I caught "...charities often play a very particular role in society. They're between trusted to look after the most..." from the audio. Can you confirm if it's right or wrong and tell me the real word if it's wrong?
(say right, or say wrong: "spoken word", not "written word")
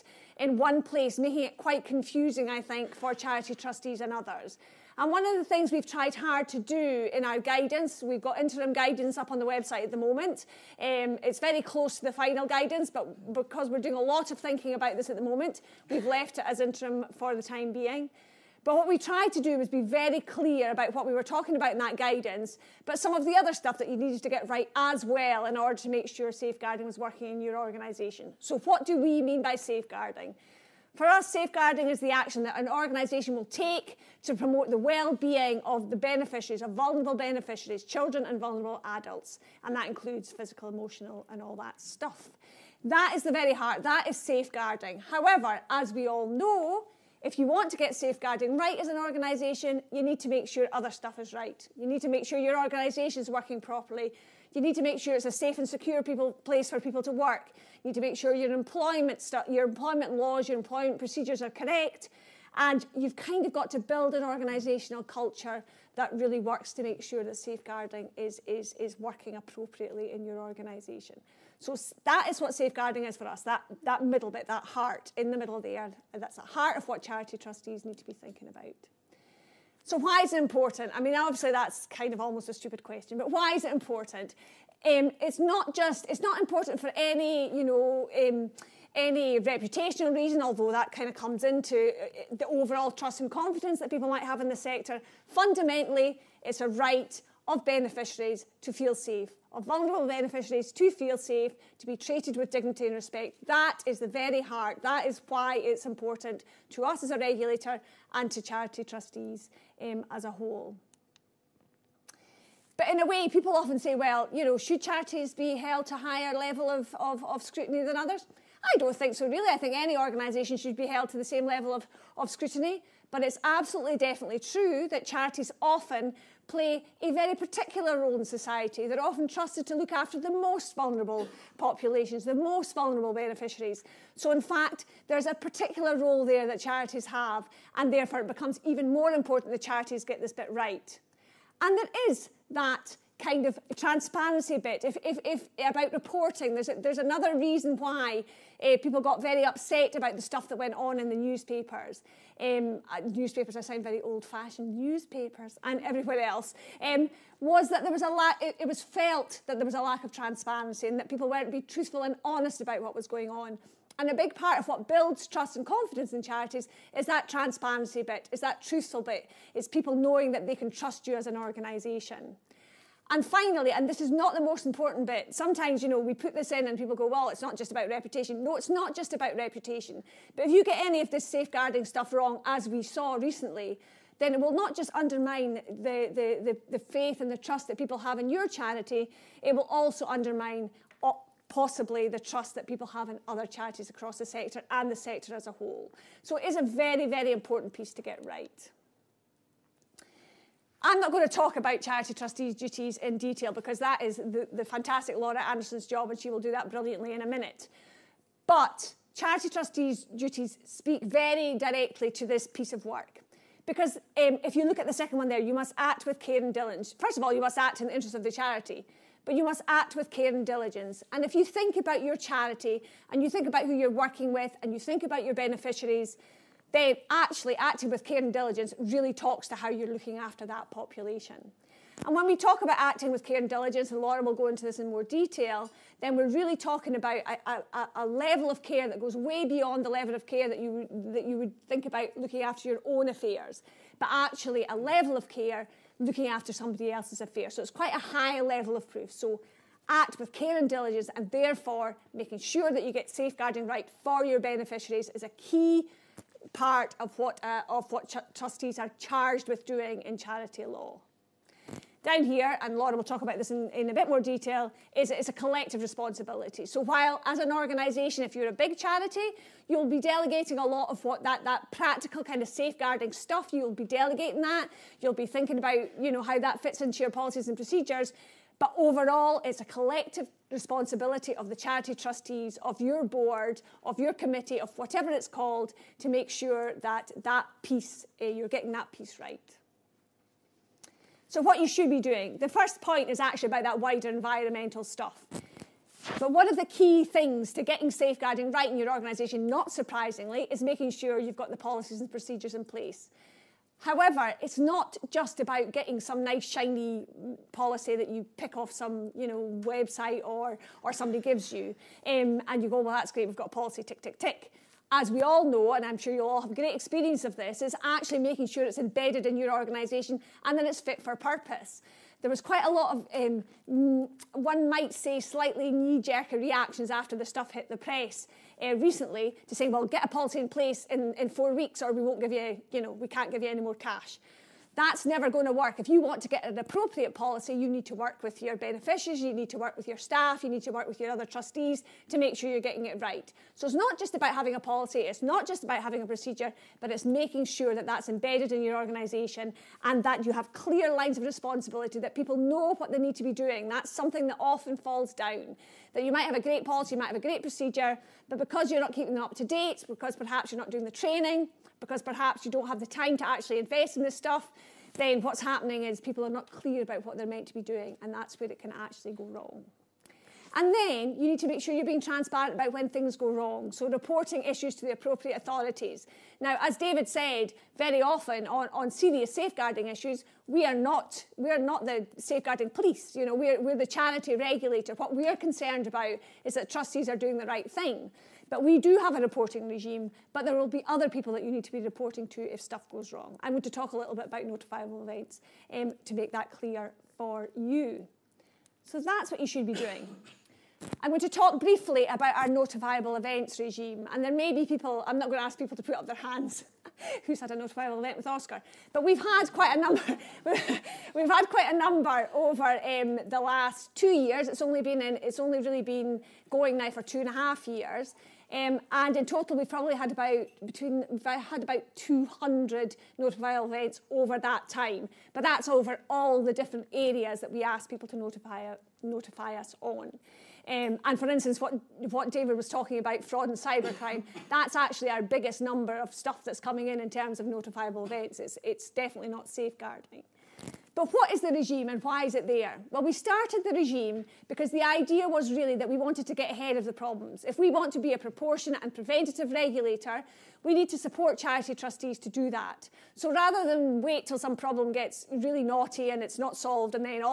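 wrong: "often", not "between".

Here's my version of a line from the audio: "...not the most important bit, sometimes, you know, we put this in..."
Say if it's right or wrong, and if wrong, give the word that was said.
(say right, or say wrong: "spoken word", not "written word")
right.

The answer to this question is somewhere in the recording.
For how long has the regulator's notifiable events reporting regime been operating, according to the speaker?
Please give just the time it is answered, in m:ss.
6:57.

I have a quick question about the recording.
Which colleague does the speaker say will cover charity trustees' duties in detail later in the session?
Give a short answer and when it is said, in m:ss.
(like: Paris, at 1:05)
Laura Anderson, at 3:25.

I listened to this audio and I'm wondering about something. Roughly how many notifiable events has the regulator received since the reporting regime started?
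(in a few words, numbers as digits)
200.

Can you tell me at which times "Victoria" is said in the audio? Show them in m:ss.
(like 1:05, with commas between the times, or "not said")
not said.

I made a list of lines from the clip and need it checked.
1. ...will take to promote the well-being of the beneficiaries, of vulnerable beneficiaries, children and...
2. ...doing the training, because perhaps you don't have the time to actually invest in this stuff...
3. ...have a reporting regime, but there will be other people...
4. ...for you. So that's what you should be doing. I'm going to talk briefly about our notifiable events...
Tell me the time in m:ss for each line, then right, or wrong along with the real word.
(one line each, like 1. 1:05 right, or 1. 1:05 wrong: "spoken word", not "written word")
1. 0:33 right
2. 6:00 right
3. 6:28 right
4. 6:37 right.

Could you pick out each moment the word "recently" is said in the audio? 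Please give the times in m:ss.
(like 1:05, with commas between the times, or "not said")
3:03, 5:28.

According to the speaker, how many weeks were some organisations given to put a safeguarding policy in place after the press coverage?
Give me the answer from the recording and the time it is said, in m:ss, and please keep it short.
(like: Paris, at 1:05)
4, at 5:31.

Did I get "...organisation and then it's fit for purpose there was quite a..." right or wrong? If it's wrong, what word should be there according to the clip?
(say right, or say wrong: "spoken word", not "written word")
right.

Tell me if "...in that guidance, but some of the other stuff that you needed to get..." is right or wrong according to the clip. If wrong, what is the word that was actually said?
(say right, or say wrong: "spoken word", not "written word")
right.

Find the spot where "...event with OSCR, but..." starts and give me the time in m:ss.
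6:47.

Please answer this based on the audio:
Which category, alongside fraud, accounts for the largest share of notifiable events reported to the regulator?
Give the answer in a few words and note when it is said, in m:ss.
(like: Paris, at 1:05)
cybercrime, at 7:13.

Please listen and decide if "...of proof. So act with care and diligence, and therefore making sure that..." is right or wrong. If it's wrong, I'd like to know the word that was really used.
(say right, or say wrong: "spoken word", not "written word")
right.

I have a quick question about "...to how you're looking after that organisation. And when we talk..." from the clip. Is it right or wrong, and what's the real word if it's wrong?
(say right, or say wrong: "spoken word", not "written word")
wrong: "population", not "organisation".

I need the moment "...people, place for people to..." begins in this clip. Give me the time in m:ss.
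0:56.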